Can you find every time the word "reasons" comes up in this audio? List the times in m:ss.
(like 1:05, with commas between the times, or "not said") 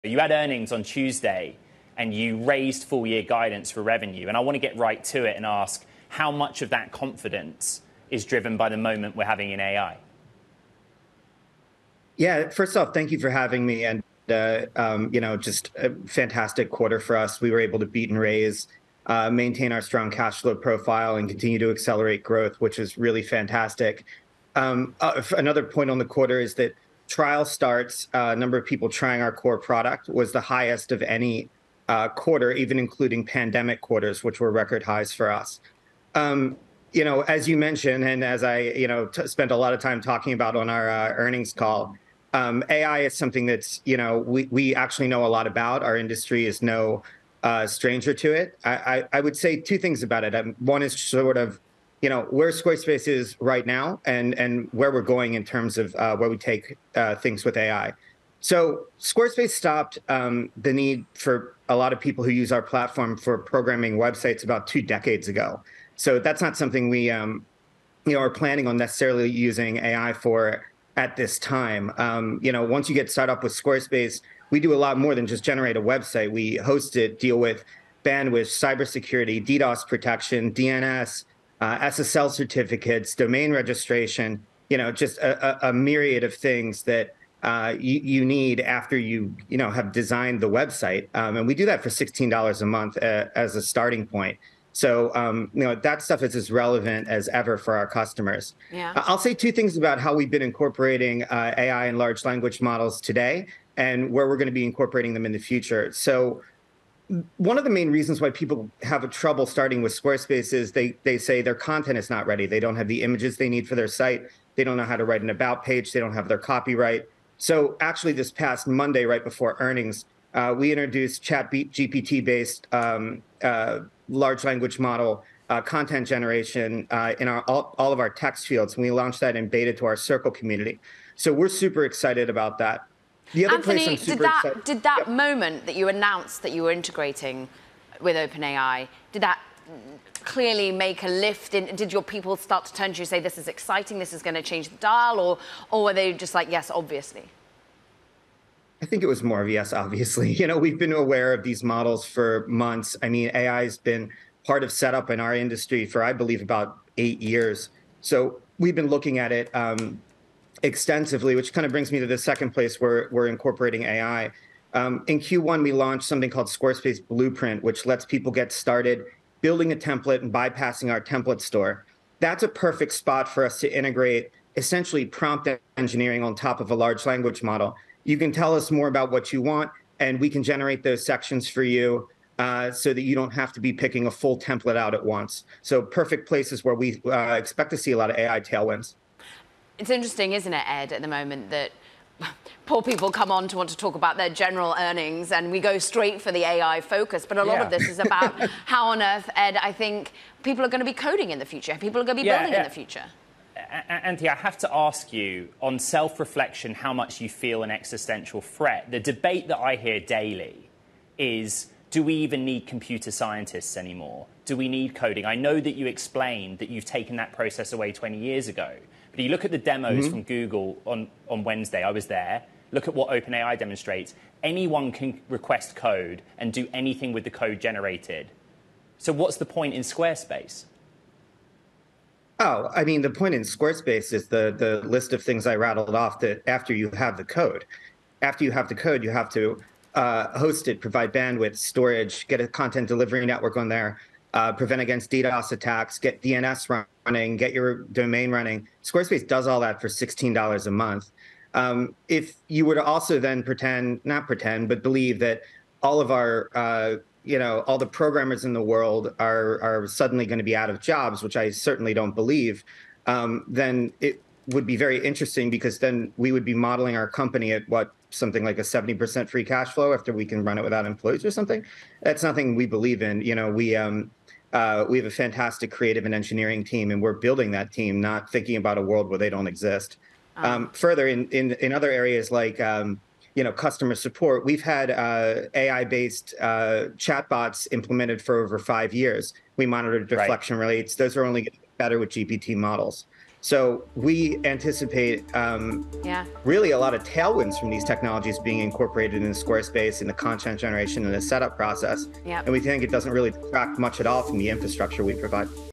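1:47.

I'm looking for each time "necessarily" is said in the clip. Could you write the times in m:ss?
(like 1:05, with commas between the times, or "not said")
1:08.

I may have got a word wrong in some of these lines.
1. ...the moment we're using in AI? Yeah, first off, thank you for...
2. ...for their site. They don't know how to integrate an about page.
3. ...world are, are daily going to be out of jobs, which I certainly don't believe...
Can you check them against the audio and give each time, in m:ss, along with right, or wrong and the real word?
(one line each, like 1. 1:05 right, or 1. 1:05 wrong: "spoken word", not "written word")
1. 0:08 wrong: "having", not "using"
2. 1:53 wrong: "write", not "integrate"
3. 4:18 wrong: "suddenly", not "daily".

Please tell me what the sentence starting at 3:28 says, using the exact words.
The debate that I hear daily is do we even need computer scientists anymore?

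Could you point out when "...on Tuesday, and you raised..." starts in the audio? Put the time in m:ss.
0:00.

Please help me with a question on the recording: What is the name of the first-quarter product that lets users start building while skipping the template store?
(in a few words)
Squarespace Blueprint.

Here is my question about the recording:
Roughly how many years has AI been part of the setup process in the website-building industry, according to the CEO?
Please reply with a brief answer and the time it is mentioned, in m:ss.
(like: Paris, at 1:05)
8 years, at 2:36.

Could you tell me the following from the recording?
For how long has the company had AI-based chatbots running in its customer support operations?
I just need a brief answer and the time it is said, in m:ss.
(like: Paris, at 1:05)
Over 5 years, at 4:48.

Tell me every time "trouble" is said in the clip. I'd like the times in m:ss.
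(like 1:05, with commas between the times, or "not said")
1:49.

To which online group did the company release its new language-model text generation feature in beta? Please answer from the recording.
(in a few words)
Circle community.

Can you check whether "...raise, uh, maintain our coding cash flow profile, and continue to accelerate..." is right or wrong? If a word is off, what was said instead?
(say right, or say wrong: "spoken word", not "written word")
wrong: "strong", not "coding".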